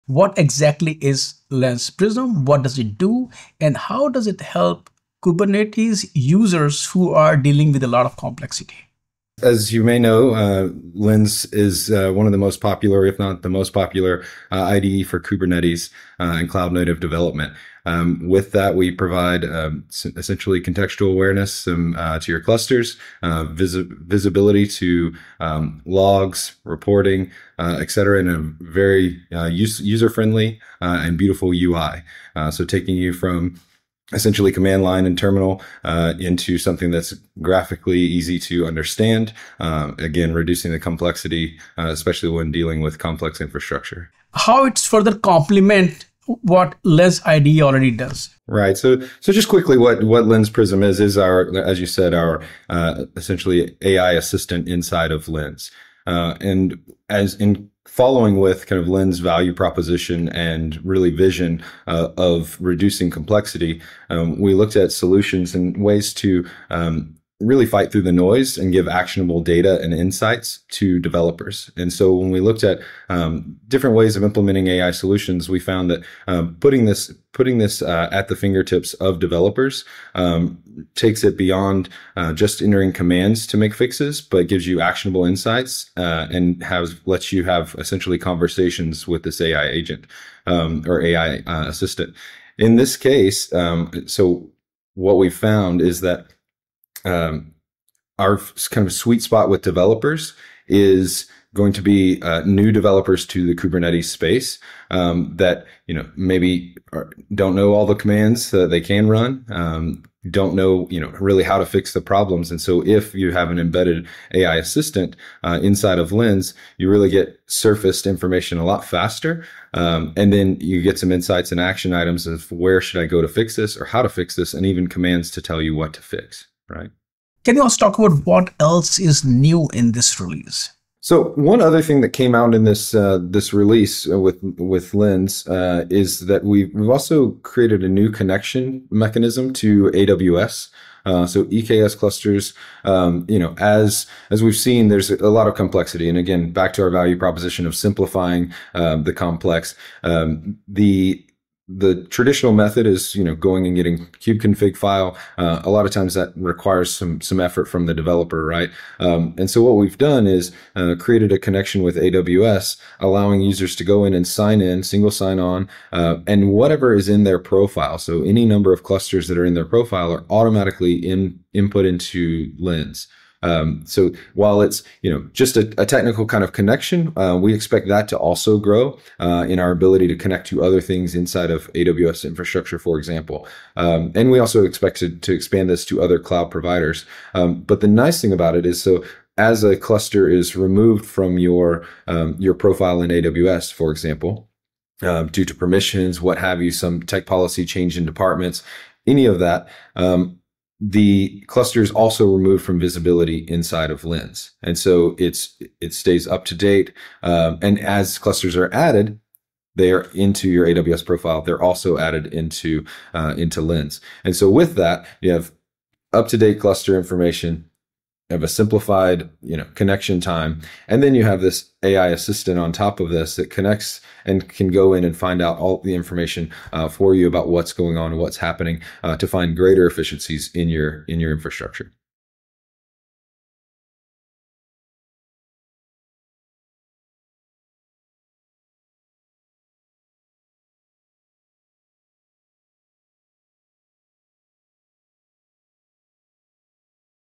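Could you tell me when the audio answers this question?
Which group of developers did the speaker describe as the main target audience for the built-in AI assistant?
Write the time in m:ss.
1:42.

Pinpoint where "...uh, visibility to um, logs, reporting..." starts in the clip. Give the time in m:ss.
0:23.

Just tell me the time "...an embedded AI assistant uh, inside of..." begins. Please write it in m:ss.
1:53.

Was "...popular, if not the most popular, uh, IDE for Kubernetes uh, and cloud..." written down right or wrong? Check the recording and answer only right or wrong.
right.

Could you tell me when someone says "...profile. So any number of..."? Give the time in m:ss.
2:47.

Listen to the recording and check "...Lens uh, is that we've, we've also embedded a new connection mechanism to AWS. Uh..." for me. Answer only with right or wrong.
wrong.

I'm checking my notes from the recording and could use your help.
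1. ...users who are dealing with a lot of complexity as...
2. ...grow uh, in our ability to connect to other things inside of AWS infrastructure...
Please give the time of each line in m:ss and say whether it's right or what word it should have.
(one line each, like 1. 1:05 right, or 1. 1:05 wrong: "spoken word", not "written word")
1. 0:06 right
2. 2:58 right.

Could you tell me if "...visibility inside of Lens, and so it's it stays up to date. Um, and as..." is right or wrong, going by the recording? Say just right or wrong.
right.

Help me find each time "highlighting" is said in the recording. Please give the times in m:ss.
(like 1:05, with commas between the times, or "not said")
not said.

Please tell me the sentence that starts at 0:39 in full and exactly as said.
Uh, again, reducing the complexity, uh, especially when dealing with complex infrastructure.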